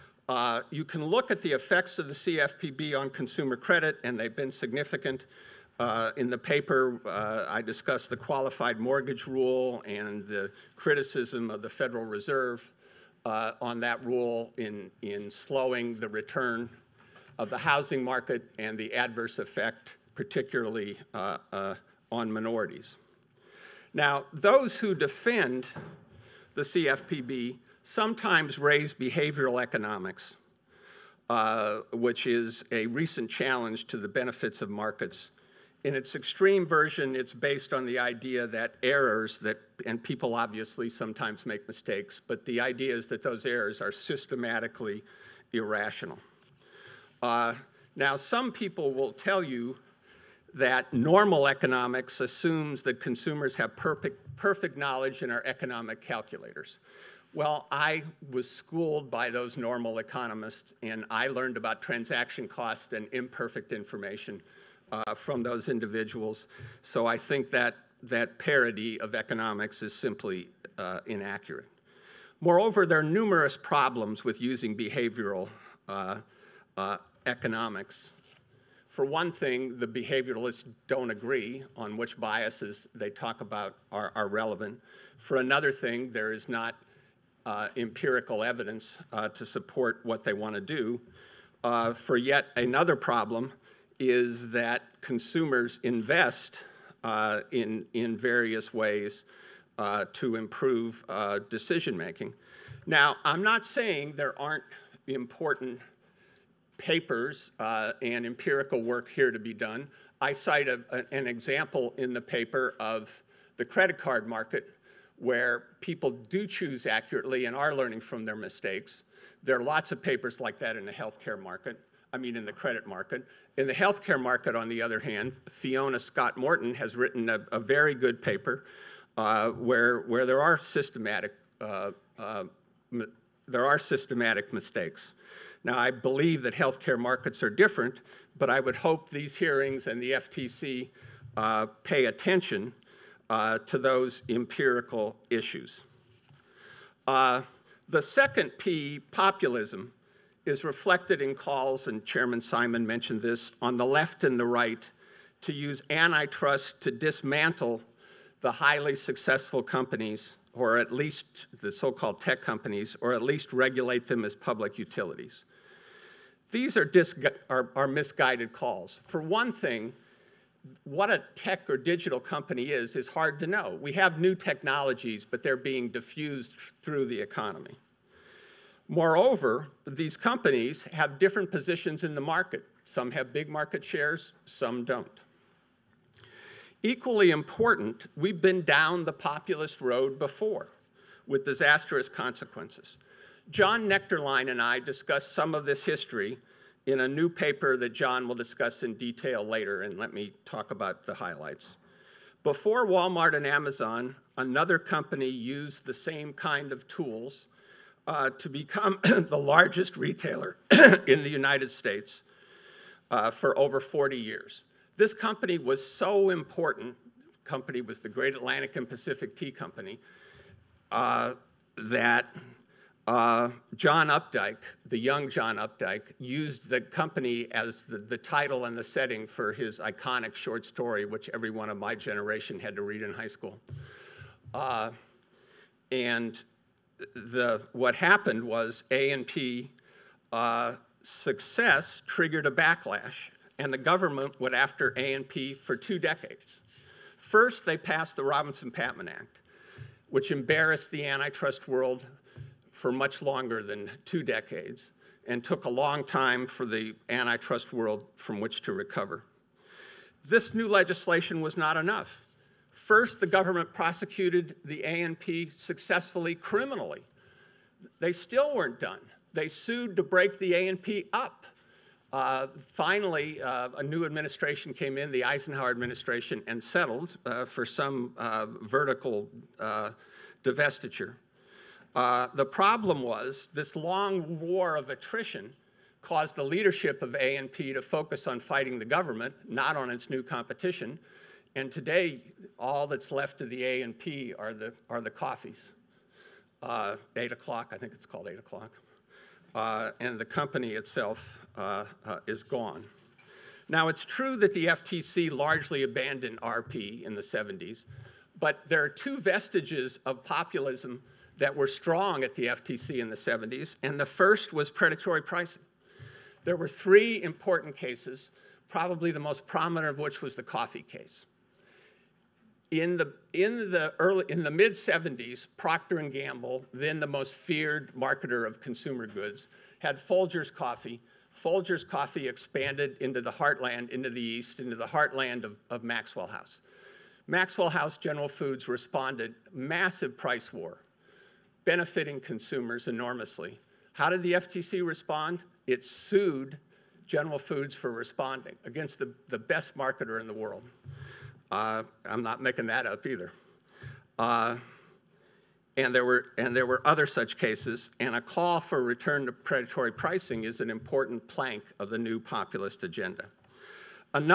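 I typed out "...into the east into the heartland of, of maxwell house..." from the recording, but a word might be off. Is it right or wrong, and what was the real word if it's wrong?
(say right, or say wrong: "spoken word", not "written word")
right.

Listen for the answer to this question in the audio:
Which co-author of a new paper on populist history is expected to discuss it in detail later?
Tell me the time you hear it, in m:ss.
3:13.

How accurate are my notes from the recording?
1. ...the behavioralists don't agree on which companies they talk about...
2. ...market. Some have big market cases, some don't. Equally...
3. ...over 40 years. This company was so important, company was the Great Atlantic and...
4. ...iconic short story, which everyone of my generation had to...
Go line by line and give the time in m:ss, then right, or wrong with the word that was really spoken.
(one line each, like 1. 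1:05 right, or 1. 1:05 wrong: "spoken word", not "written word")
1. 1:19 wrong: "biases", not "companies"
2. 3:02 wrong: "shares", not "cases"
3. 3:33 right
4. 3:49 right.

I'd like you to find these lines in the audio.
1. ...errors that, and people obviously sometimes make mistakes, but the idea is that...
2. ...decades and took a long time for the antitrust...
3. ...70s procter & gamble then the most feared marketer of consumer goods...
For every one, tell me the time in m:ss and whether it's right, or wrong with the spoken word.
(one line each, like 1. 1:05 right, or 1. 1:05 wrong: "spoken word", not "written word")
1. 0:38 right
2. 4:14 right
3. 5:24 right.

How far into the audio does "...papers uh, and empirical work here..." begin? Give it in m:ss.
1:46.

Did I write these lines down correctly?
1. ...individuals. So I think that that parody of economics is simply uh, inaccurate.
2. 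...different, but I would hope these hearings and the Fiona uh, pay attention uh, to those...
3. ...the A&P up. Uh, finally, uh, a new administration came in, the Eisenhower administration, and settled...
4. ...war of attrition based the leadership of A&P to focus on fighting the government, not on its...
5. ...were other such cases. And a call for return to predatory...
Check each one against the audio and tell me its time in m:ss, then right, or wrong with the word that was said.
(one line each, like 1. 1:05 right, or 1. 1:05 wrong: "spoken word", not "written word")
1. 1:05 right
2. 2:17 wrong: "FTC", not "Fiona"
3. 4:30 right
4. 4:44 wrong: "caused", not "based"
5. 5:56 right.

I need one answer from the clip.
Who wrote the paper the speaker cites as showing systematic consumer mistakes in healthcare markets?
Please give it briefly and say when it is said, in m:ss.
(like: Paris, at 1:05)
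Fiona Scott Morton, at 2:05.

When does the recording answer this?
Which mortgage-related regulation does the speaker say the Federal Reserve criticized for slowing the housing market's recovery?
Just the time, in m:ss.
0:08.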